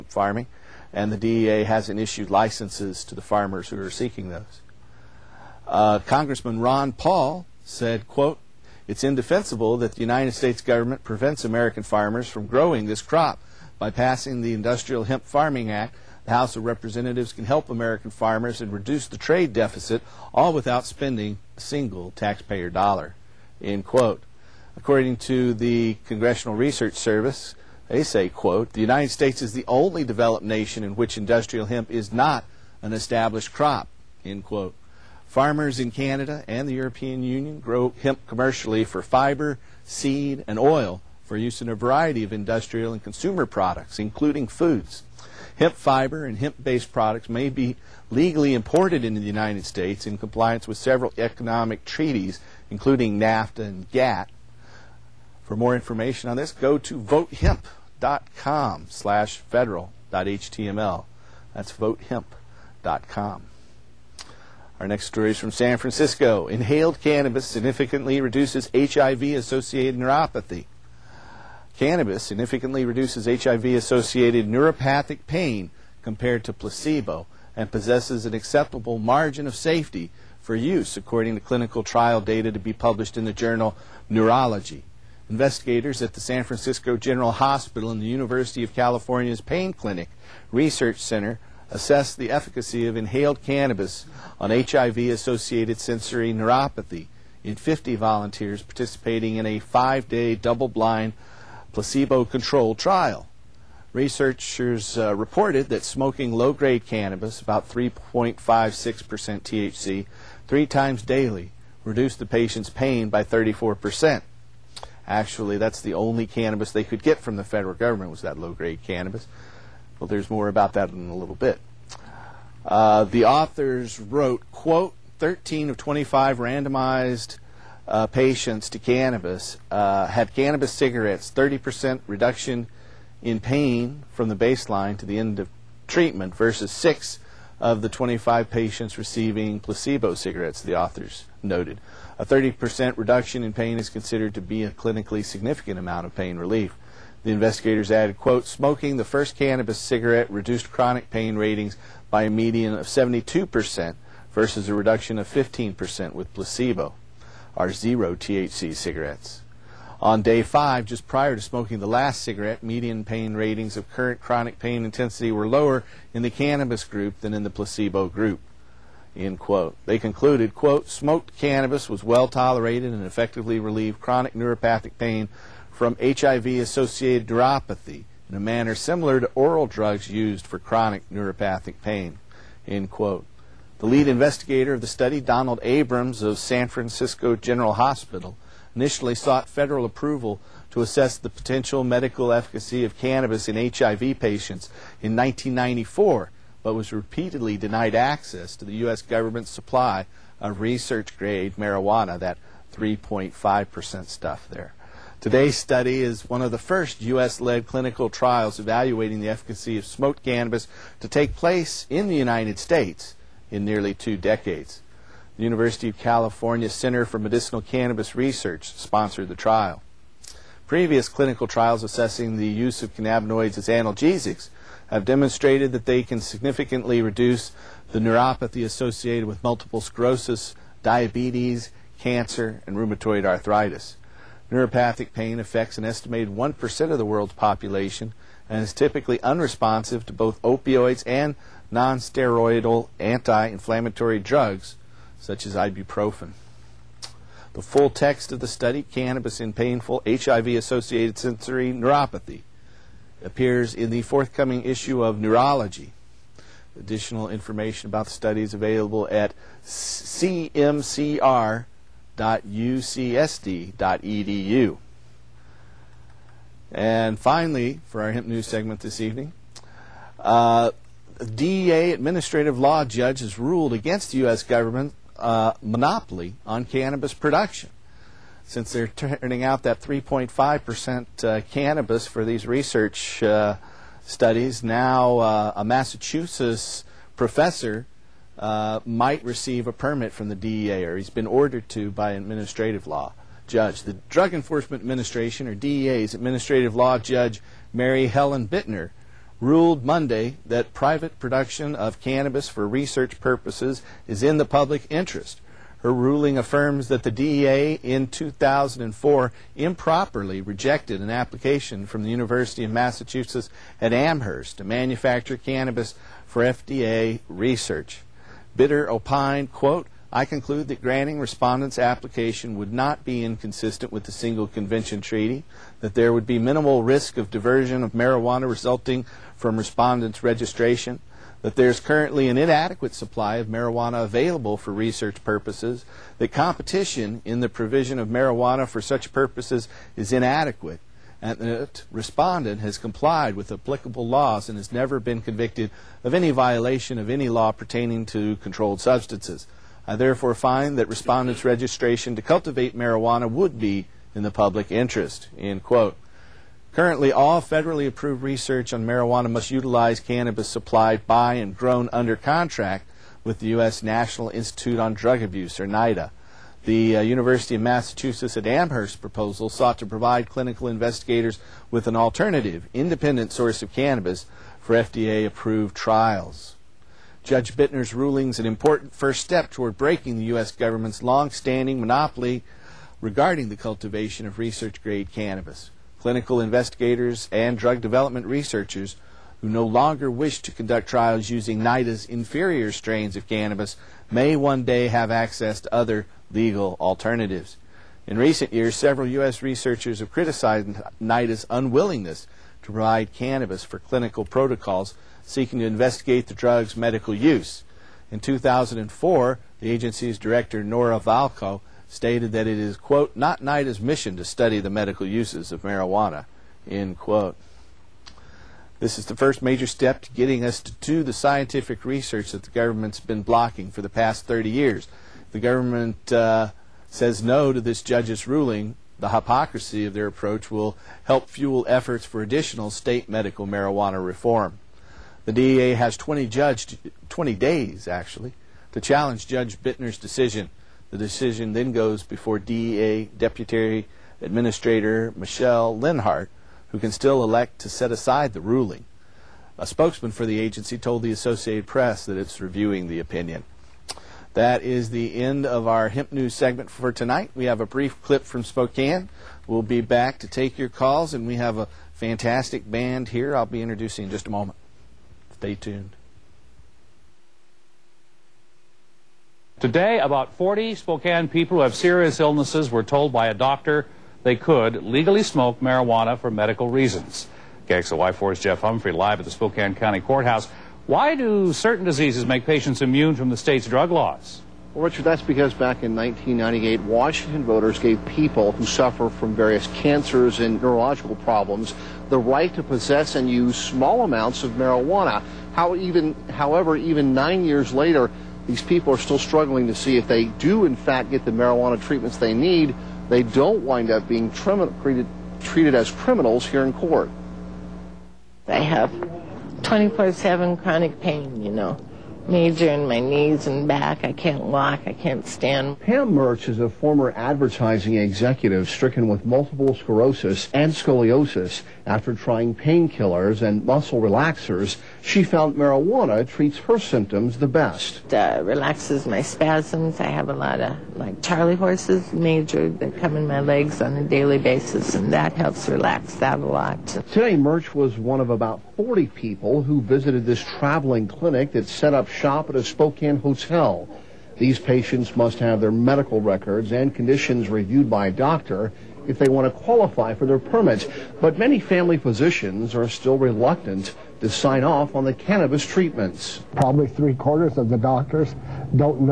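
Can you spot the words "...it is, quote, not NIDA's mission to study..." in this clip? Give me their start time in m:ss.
6:52.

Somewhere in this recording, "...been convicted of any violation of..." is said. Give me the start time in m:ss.
5:44.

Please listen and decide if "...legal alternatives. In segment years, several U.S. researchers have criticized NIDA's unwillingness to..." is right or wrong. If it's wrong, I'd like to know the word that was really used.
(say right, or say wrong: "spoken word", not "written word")
wrong: "recent", not "segment".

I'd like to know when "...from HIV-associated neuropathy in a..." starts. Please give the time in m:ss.
2:55.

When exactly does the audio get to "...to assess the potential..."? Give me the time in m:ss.
3:10.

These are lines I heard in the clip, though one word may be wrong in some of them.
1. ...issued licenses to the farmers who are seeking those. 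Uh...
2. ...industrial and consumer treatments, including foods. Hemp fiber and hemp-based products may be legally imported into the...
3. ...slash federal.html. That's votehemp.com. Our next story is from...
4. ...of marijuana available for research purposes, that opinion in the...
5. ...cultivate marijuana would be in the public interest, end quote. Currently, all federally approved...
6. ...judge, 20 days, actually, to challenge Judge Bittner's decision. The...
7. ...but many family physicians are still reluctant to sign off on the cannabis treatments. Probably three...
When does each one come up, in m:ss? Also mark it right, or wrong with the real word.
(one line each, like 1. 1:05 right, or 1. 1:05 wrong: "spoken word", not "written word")
1. 0:01 right
2. 0:42 wrong: "products", not "treatments"
3. 0:58 right
4. 5:33 wrong: "competition", not "opinion"
5. 5:52 right
6. 7:16 right
7. 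9:11 right.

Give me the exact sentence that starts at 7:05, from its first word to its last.
The government uh, says no to this judge's ruling.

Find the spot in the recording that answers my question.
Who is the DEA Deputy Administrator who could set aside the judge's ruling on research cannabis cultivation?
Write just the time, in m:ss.
7:25.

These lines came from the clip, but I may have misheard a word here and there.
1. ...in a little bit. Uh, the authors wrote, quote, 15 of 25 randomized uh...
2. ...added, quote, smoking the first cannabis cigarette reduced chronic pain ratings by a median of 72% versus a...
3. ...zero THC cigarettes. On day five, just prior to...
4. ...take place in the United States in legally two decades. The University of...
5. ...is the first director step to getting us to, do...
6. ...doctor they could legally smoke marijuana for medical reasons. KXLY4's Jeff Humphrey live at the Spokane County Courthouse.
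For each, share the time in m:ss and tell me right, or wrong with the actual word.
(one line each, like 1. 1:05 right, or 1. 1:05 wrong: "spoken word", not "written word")
1. 2:00 wrong: "13", not "15"
2. 2:27 right
3. 2:37 right
4. 3:31 wrong: "nearly", not "legally"
5. 6:58 wrong: "major", not "director"
6. 7:53 right.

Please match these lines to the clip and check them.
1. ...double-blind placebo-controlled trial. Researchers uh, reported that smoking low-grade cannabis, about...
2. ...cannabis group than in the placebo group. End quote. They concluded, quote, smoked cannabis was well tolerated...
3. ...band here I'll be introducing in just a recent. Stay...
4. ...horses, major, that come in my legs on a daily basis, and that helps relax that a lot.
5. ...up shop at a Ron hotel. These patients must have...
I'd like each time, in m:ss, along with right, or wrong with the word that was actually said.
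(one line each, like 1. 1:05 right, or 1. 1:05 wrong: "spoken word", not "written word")
1. 1:40 right
2. 2:46 right
3. 7:42 wrong: "moment", not "recent"
4. 8:51 right
5. 9:01 wrong: "Spokane", not "Ron".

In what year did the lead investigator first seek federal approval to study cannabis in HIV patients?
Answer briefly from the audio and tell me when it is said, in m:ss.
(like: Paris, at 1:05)
1994, at 3:15.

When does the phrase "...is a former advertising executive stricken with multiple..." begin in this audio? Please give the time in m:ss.
8:36.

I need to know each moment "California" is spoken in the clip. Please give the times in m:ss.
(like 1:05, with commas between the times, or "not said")
1:28, 3:35.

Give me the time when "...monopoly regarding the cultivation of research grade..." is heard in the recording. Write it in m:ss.
6:21.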